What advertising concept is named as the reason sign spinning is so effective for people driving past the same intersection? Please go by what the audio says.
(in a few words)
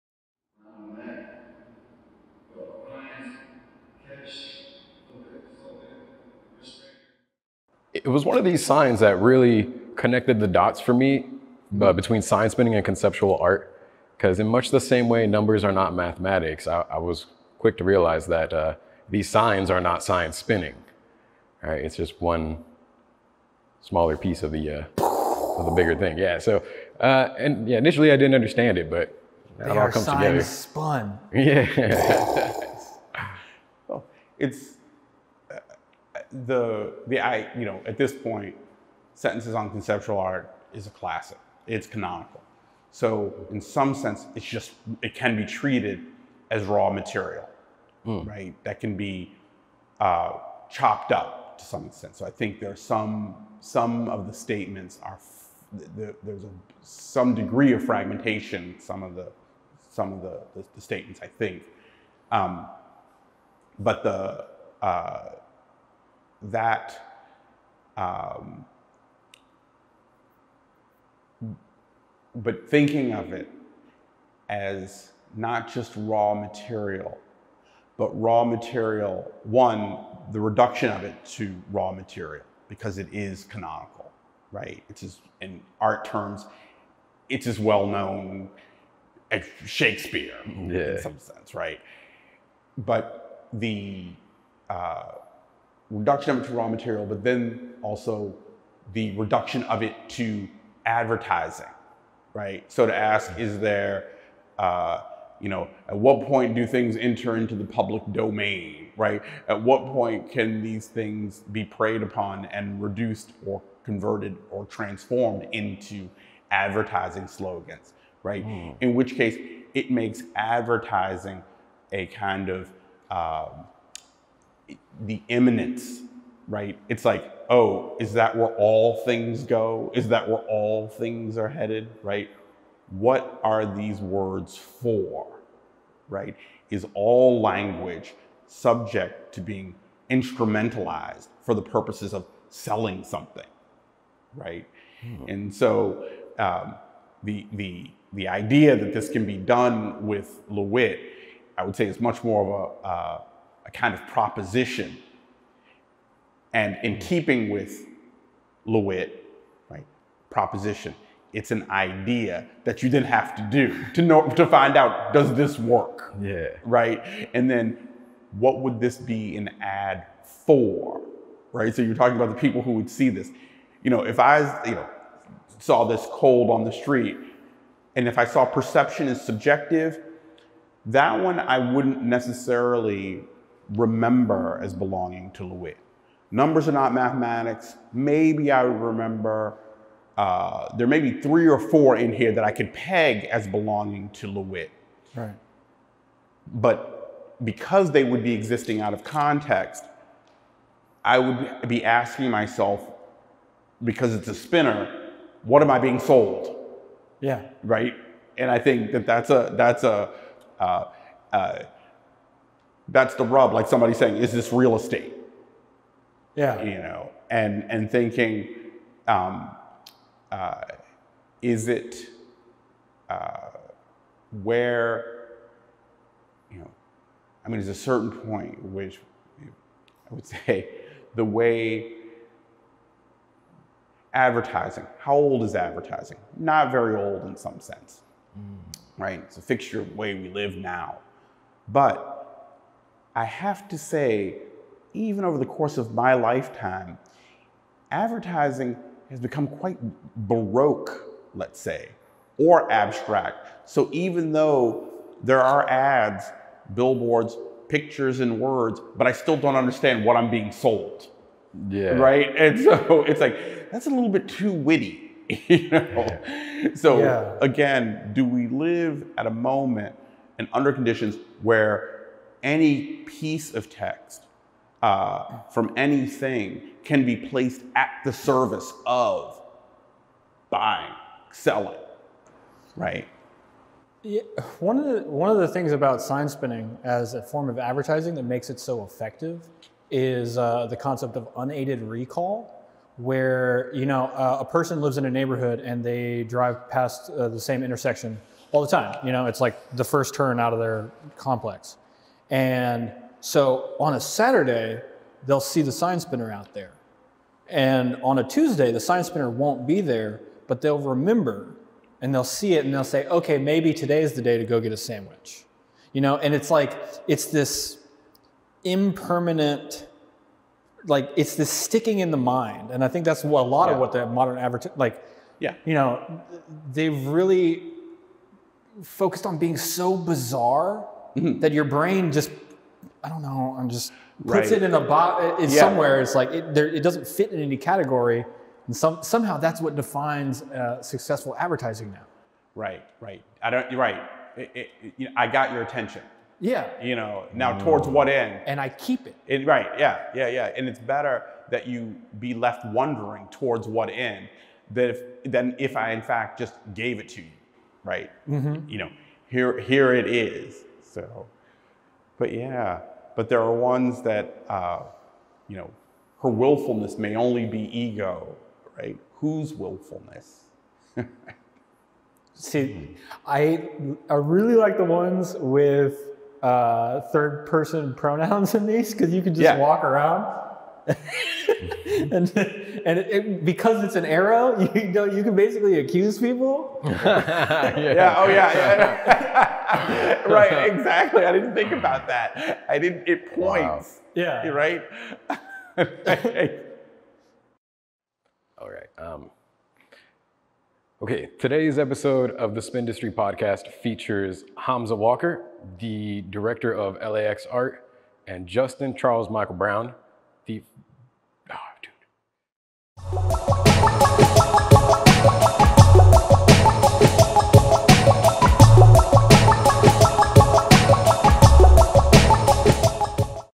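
Unaided recall.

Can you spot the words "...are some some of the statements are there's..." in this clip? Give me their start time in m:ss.
0:52.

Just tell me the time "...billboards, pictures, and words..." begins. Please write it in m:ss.
4:16.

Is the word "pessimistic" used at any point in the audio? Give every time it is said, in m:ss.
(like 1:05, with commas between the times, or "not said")
not said.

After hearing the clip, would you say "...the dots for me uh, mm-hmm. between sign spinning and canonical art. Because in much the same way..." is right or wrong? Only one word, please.
wrong.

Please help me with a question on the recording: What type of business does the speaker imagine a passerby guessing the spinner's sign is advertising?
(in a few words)
Real estate.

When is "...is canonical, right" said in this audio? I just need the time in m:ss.
1:23.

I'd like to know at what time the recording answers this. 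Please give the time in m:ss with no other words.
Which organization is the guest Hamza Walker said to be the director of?
6:46.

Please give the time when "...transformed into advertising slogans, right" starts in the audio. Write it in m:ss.
1:54.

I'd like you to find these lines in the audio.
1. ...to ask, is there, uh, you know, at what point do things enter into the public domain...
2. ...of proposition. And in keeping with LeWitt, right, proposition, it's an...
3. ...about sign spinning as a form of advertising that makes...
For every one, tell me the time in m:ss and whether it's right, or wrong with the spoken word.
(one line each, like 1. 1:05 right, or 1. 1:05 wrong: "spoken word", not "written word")
1. 1:42 right
2. 2:33 right
3. 4:45 right.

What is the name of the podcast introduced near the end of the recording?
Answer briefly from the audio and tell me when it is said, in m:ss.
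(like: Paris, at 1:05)
SPINdustry, at 6:42.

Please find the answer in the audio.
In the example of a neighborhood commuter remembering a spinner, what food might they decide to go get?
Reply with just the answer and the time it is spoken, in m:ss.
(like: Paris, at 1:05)
A sandwich, at 5:14.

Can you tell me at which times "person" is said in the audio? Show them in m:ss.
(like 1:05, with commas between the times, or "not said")
4:54, 6:17.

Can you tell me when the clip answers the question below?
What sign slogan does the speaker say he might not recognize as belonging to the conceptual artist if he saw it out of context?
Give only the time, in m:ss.
2:58.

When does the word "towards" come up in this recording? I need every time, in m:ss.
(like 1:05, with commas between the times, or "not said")
5:47, 5:53.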